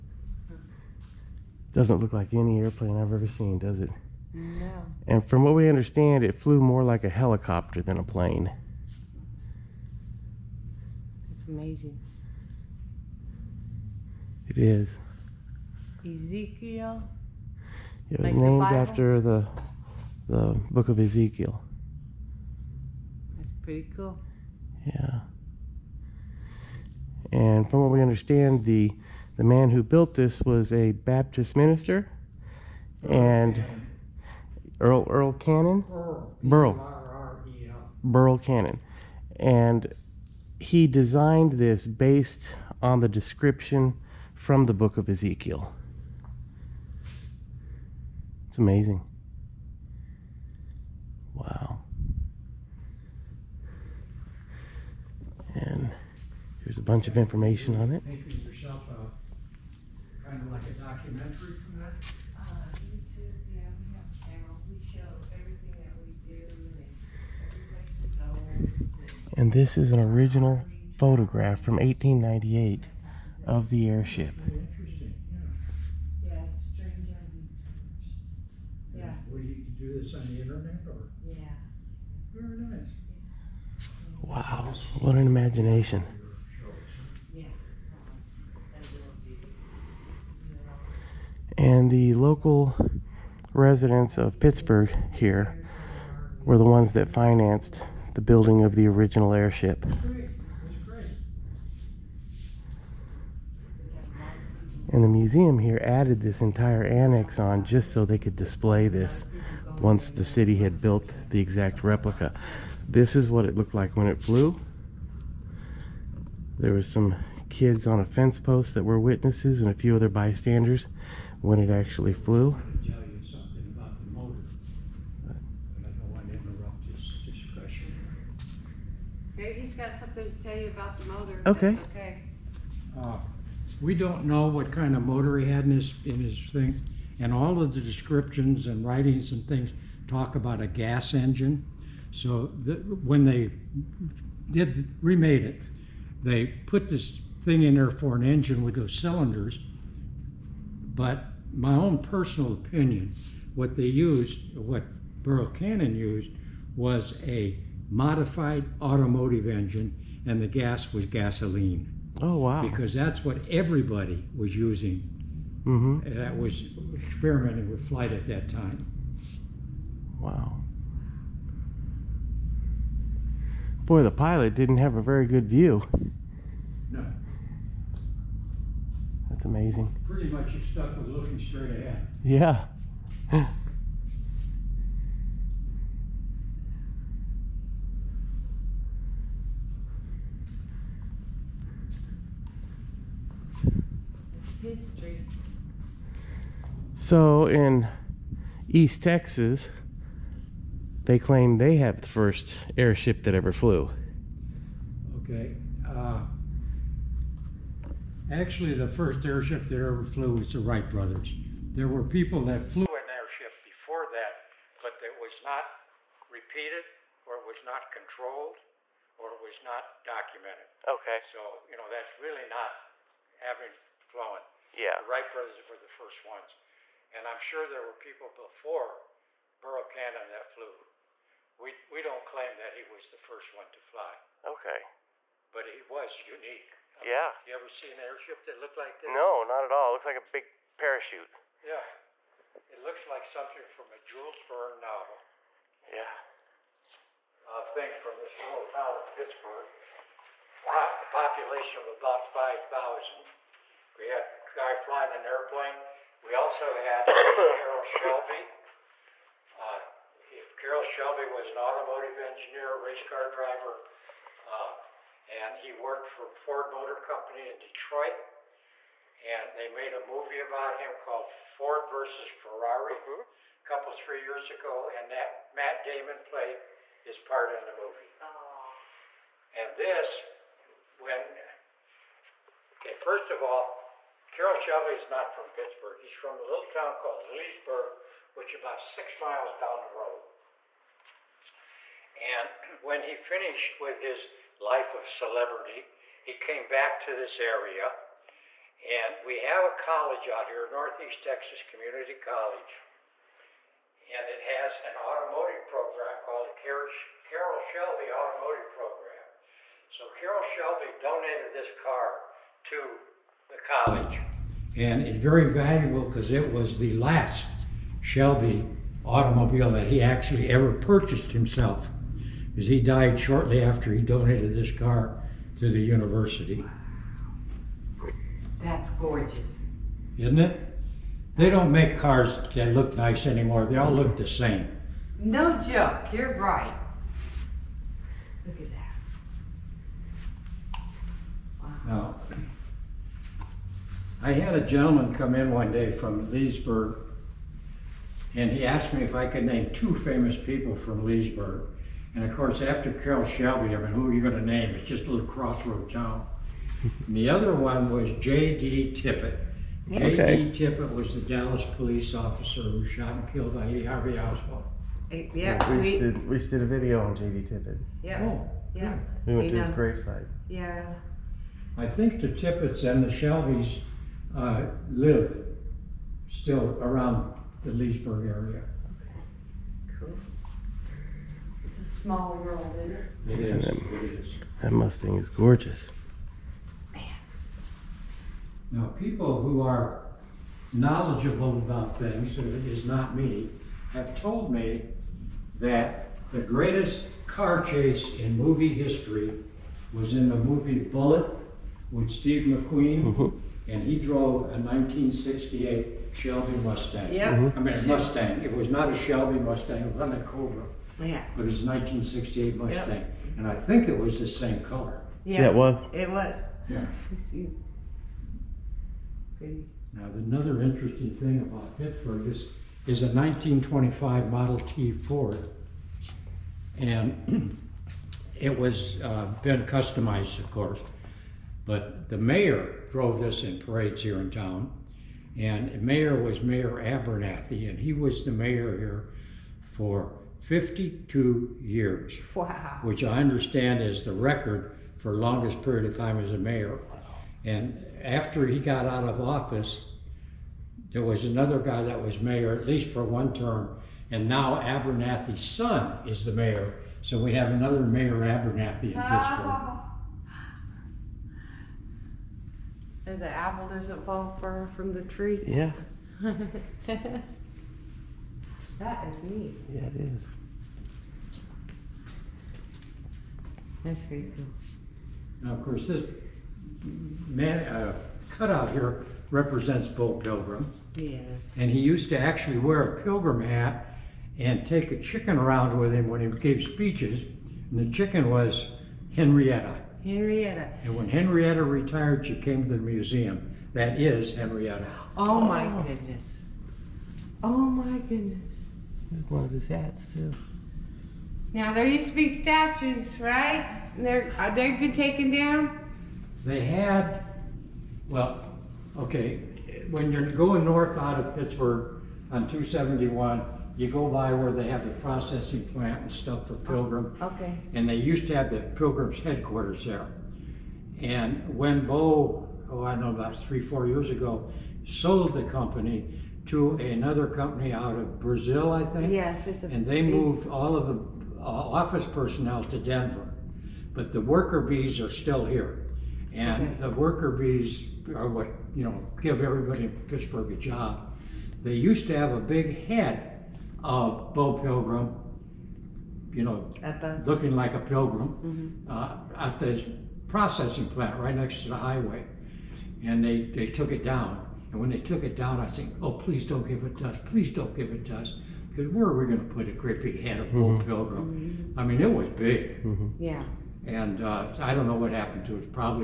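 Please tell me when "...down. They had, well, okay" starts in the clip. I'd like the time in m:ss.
8:25.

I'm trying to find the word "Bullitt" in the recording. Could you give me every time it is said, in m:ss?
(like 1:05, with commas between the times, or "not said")
6:40.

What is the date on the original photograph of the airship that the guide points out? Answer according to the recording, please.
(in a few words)
1898.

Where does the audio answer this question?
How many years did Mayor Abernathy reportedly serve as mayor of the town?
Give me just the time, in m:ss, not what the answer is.
7:20.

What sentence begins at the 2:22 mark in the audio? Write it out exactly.
So the, when they did remade it, they put this thing in there for an engine with those cylinders.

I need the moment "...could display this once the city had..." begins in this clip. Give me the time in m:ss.
1:48.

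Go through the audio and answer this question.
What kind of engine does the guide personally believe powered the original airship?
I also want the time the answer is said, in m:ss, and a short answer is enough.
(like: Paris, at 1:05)
modified automotive engine, at 2:37.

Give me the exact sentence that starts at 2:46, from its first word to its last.
that was experimenting with flight at that time.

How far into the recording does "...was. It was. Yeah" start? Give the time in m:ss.
6:55.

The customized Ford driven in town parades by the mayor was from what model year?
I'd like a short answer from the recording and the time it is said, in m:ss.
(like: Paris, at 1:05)
1925, at 7:03.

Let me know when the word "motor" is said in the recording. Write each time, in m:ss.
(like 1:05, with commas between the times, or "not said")
2:15, 4:26.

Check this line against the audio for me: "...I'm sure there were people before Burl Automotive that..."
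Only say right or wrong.
wrong.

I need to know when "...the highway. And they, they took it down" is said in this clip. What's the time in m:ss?
9:11.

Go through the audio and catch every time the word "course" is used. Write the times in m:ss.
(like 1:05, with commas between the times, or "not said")
5:52, 7:10, 7:55.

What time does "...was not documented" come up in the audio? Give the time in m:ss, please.
3:39.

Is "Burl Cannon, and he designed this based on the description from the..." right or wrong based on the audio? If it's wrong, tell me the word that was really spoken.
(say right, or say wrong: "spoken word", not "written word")
right.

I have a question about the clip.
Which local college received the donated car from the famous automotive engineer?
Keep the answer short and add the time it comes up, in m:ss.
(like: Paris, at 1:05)
Northeast Texas Community College, at 5:00.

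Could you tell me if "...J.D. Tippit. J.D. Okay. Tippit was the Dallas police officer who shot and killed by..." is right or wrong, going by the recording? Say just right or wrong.
right.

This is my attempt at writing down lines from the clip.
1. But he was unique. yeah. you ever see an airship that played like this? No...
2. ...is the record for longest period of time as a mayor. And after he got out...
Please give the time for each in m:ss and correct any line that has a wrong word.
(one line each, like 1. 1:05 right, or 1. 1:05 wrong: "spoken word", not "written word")
1. 3:55 wrong: "looked", not "played"
2. 7:23 right.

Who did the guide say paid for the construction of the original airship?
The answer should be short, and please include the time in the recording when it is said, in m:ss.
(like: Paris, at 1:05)
local residents of Pittsburg, at 1:32.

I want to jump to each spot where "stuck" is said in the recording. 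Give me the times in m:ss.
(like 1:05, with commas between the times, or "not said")
3:00.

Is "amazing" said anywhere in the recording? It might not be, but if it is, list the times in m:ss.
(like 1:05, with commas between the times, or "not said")
0:11, 0:48, 2:59.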